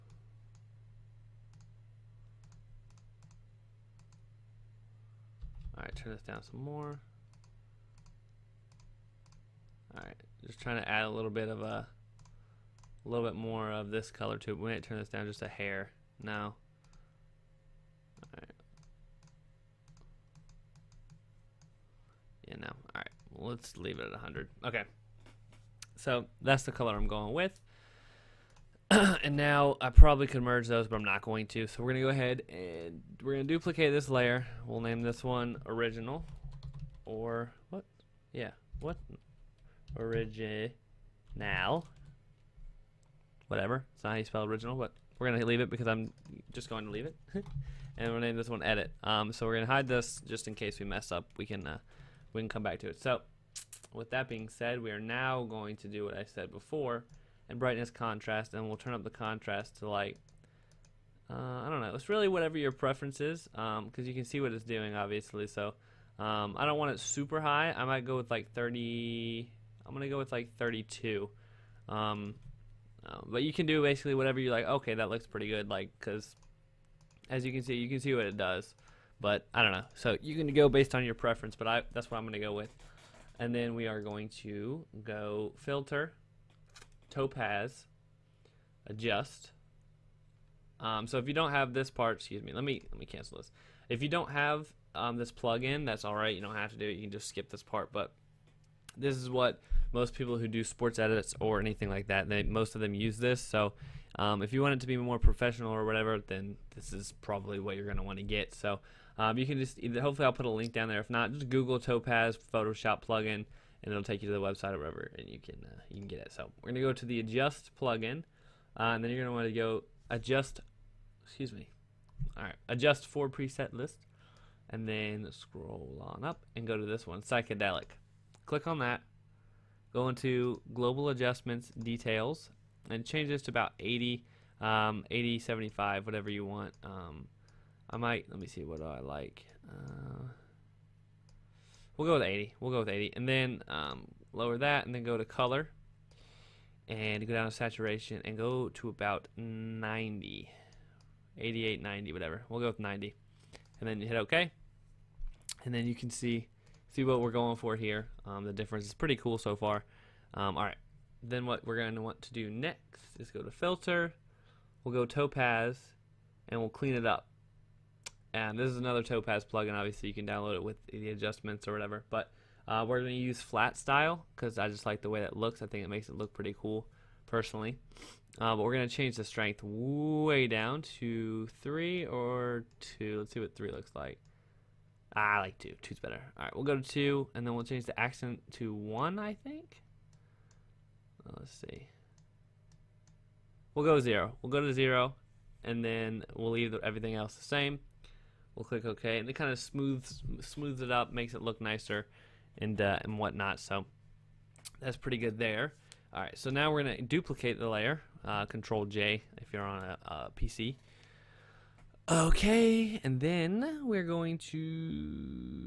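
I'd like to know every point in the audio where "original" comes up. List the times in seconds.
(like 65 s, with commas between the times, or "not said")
35 s, 39 s, 44 s.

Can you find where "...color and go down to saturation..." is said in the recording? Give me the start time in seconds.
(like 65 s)
145 s.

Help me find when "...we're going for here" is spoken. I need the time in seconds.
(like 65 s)
157 s.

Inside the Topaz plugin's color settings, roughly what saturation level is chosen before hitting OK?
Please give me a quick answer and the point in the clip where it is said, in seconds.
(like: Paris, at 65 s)
90, at 152 s.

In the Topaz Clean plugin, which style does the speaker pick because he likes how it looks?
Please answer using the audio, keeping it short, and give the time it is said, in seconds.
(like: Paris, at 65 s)
Flat style, at 173 s.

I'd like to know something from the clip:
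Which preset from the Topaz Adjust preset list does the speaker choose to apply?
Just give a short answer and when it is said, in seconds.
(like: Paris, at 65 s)
Psychedelic, at 127 s.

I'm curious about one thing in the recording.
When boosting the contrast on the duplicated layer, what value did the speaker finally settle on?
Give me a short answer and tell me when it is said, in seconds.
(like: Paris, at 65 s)
32, at 70 s.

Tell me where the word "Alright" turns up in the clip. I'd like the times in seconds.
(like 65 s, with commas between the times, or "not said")
18 s, 22 s.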